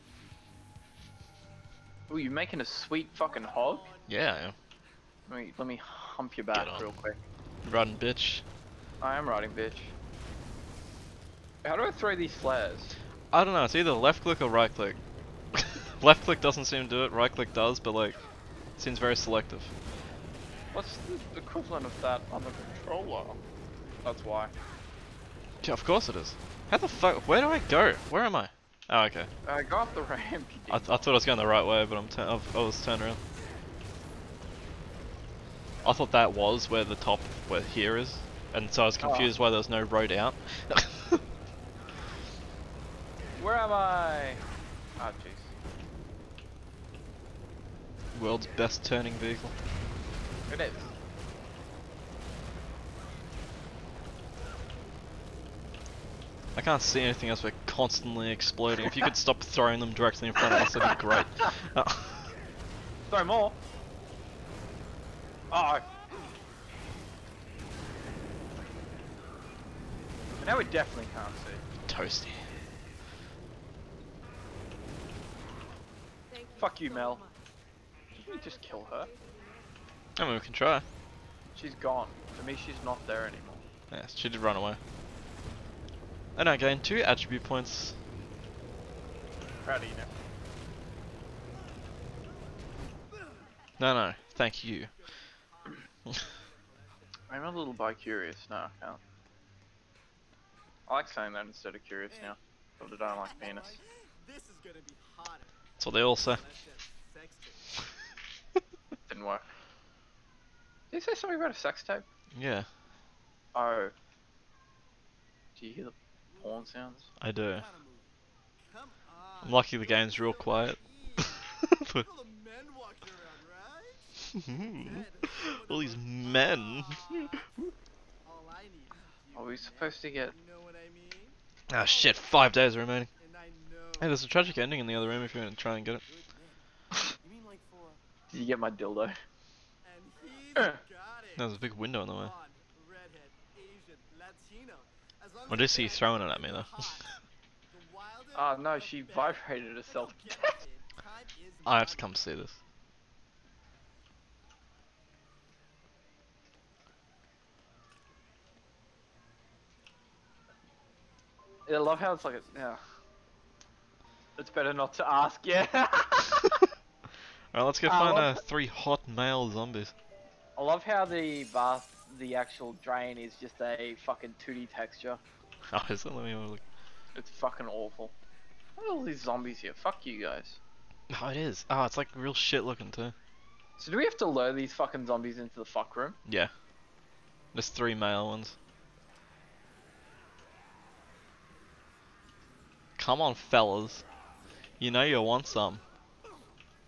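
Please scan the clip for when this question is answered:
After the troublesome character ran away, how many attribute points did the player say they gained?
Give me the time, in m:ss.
1:26.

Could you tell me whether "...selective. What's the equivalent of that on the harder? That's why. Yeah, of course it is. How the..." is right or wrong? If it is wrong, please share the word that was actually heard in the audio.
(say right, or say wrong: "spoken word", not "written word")
wrong: "controller", not "harder".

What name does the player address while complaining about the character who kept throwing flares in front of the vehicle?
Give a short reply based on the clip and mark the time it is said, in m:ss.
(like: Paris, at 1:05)
Mel, at 1:16.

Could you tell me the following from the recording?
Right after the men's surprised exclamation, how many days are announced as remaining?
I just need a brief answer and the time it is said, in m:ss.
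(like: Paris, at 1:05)
5, at 2:12.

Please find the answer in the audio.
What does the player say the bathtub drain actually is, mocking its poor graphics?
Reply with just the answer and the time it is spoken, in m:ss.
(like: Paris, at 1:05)
2D texture, at 2:54.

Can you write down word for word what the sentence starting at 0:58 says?
If you could stop throwing them directly in front of us, that'd be great.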